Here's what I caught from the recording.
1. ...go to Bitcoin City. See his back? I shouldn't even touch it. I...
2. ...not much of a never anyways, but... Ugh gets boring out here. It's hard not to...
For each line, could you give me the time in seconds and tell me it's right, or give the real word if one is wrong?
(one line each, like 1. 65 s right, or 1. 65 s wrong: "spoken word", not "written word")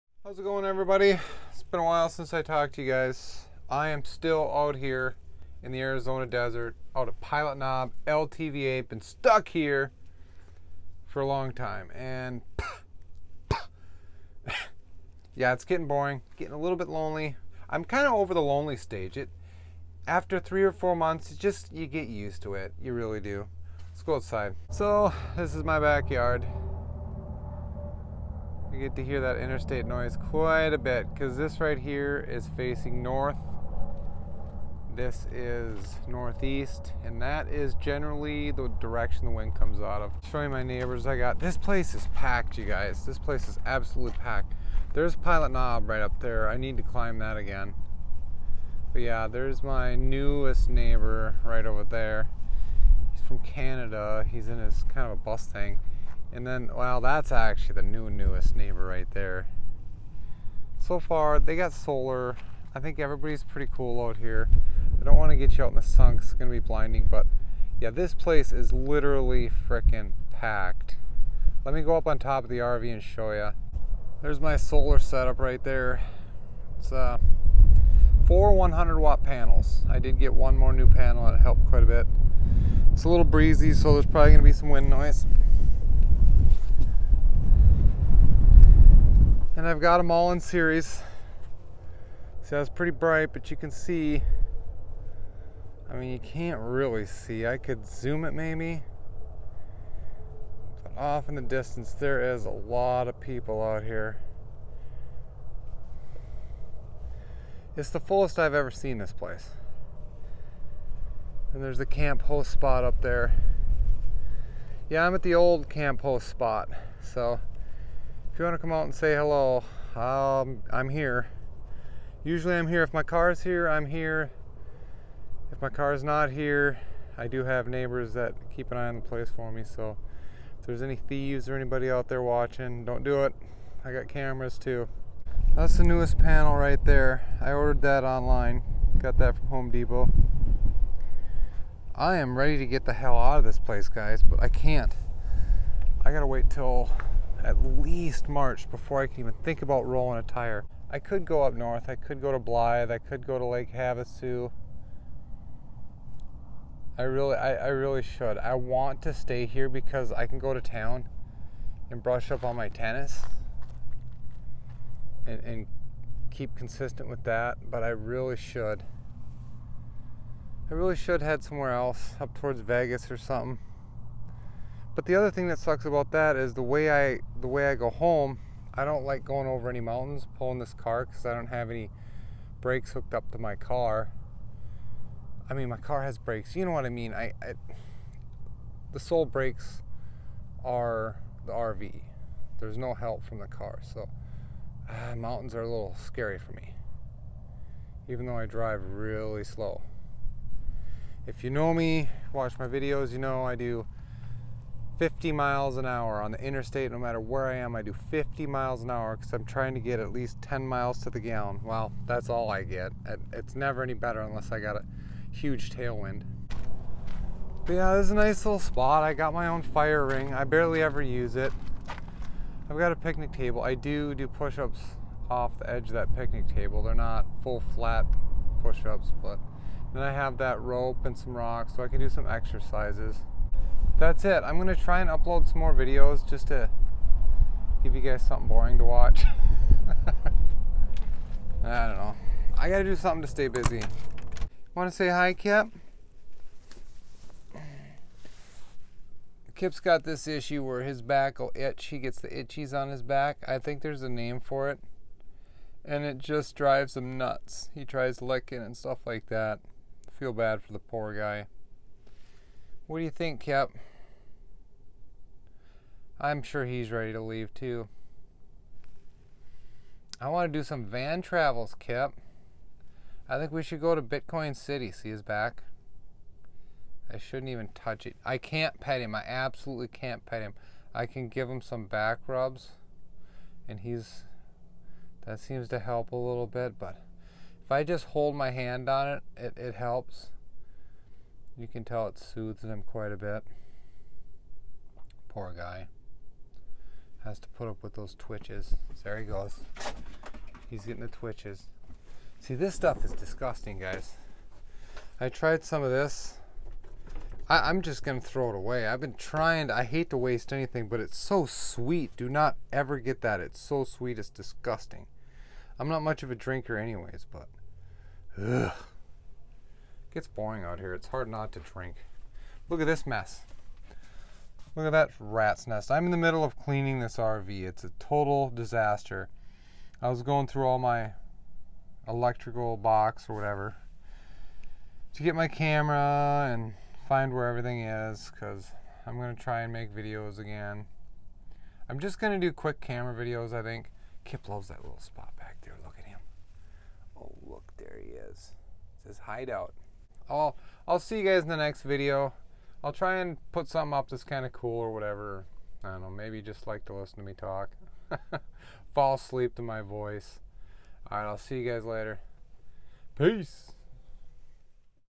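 1. 273 s right
2. 315 s wrong: "drinker", not "never".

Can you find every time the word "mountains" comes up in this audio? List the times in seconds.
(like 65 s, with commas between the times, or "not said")
179 s, 195 s.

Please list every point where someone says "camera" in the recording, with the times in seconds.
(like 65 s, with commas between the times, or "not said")
134 s, 335 s, 342 s.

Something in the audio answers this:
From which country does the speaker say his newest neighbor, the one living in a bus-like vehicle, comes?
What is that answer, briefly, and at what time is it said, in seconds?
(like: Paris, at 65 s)
Canada, at 53 s.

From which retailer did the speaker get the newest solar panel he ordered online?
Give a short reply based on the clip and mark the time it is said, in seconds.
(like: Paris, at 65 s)
Home Depot, at 139 s.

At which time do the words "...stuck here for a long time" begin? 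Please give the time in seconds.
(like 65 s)
9 s.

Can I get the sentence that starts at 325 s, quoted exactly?
I'm in the middle of cleaning this RV.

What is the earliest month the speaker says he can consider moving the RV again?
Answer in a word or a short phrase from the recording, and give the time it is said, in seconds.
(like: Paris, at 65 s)
March, at 148 s.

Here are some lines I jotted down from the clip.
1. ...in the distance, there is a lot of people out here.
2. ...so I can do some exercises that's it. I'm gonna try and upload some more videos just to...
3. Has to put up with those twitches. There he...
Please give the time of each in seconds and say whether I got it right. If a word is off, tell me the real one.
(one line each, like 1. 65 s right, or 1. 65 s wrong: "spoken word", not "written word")
1. 101 s right
2. 231 s right
3. 297 s right.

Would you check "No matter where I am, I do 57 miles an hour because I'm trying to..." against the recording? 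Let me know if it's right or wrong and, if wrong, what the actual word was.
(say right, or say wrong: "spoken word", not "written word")
wrong: "50", not "57".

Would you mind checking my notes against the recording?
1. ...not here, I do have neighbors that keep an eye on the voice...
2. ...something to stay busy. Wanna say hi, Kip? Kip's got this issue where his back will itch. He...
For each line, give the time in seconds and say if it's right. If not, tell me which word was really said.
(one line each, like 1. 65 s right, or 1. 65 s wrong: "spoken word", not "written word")
1. 126 s wrong: "place", not "voice"
2. 242 s right.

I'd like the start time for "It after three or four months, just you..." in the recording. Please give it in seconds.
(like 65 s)
19 s.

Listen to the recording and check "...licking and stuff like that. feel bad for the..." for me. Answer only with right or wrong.
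right.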